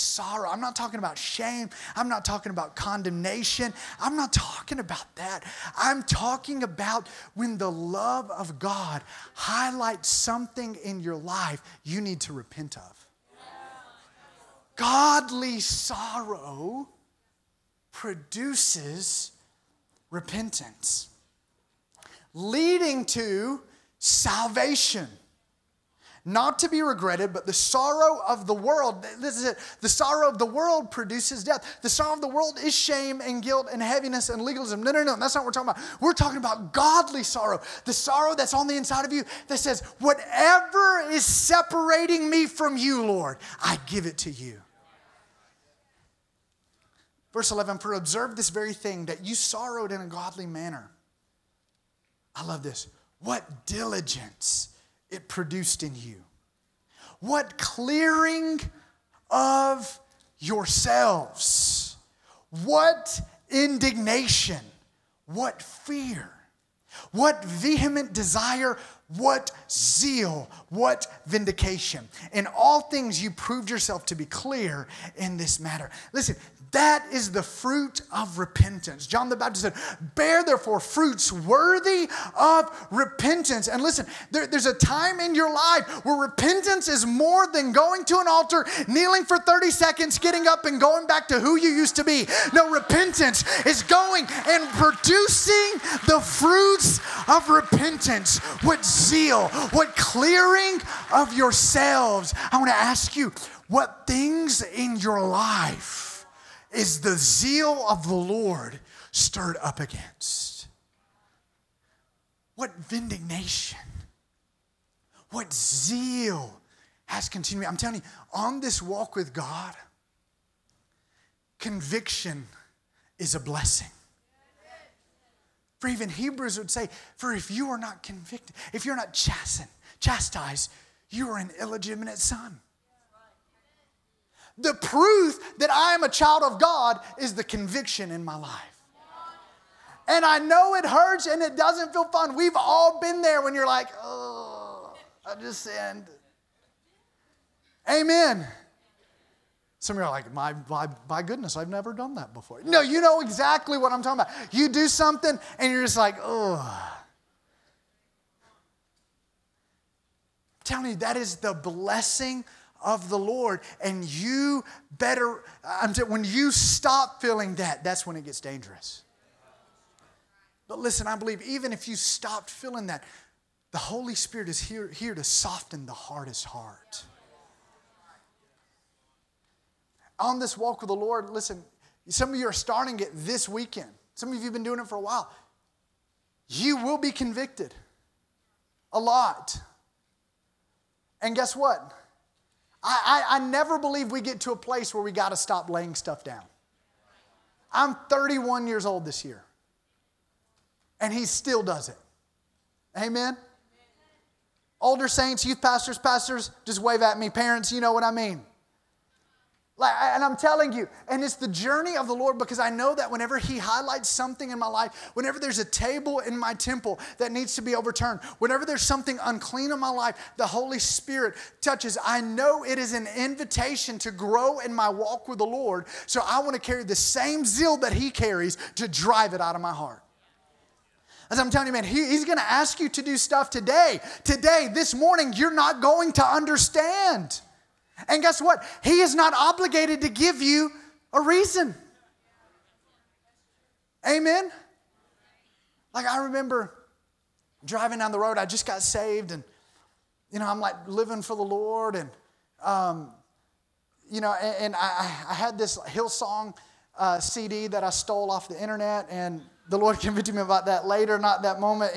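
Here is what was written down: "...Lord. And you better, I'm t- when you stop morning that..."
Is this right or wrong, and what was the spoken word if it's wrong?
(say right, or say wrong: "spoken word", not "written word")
wrong: "feeling", not "morning".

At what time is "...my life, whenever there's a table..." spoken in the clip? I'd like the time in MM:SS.
03:34.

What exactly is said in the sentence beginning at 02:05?
For even Hebrews would say, For if you are not convicted, if you're not chastened, chastised, you are an illegitimate son.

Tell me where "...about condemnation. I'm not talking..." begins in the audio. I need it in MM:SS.
00:02.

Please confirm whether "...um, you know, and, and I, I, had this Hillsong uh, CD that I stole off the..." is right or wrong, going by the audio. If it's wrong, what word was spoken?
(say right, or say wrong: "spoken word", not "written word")
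right.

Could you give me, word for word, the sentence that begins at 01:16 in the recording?
Listen, that is the fruit of repentance.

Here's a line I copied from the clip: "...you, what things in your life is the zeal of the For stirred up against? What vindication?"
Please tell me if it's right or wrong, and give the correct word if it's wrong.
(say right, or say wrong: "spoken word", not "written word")
wrong: "Lord", not "For".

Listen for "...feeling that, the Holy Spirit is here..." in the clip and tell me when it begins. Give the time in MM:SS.
02:52.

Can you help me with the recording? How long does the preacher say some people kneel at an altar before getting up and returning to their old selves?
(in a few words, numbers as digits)
30 seconds.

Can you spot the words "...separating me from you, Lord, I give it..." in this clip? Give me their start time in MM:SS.
00:41.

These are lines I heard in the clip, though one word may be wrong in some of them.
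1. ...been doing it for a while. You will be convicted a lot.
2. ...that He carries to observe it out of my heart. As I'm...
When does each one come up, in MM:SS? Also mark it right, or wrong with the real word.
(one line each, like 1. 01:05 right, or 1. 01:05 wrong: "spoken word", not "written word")
1. 03:04 right
2. 03:47 wrong: "drive", not "observe".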